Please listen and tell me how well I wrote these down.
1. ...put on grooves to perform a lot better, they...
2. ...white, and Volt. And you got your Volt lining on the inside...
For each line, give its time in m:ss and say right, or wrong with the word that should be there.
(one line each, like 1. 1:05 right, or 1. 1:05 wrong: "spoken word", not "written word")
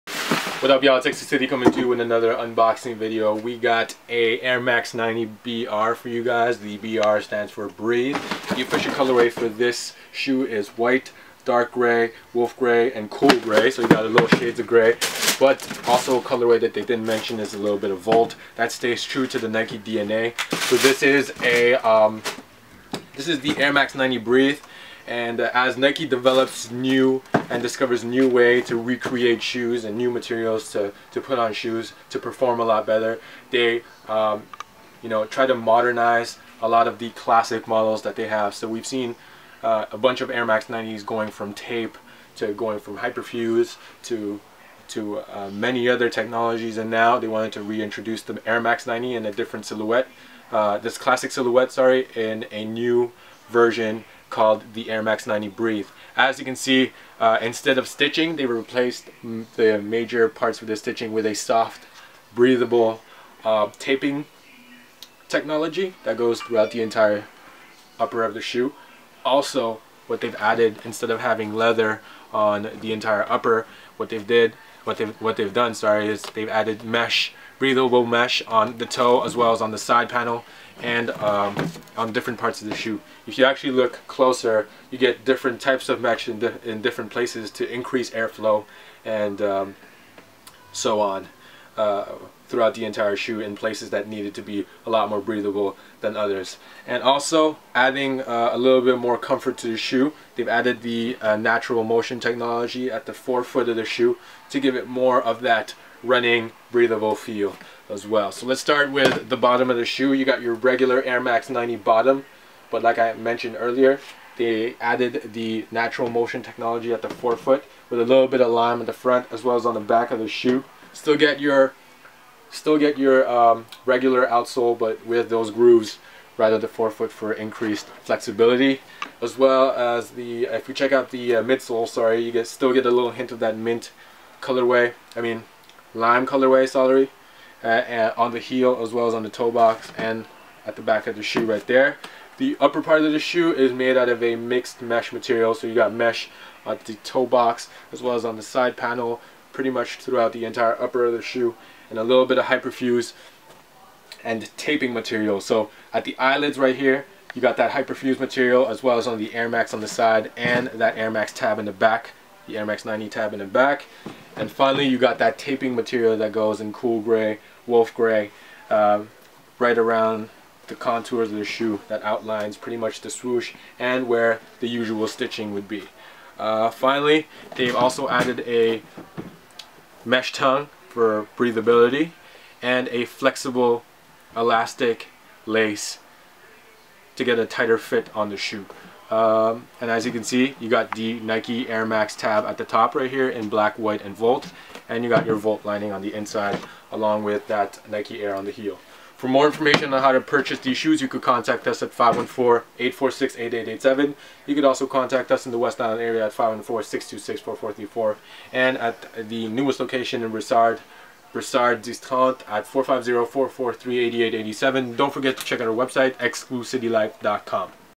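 1. 0:31 wrong: "shoes", not "grooves"
2. 3:13 right.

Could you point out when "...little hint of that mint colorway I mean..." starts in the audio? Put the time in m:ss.
2:12.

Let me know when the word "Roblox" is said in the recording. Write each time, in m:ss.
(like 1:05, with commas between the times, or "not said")
not said.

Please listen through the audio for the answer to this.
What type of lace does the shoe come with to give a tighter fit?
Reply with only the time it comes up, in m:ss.
3:03.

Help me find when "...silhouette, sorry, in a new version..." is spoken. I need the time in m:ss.
0:51.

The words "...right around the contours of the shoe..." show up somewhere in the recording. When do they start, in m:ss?
2:49.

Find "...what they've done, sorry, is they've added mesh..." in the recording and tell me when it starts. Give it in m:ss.
1:15.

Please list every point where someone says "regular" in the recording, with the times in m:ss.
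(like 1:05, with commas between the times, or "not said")
1:50, 2:03.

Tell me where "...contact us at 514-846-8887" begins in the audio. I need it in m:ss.
3:21.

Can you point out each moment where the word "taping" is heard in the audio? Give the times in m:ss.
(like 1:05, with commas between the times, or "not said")
1:03, 2:34, 2:45.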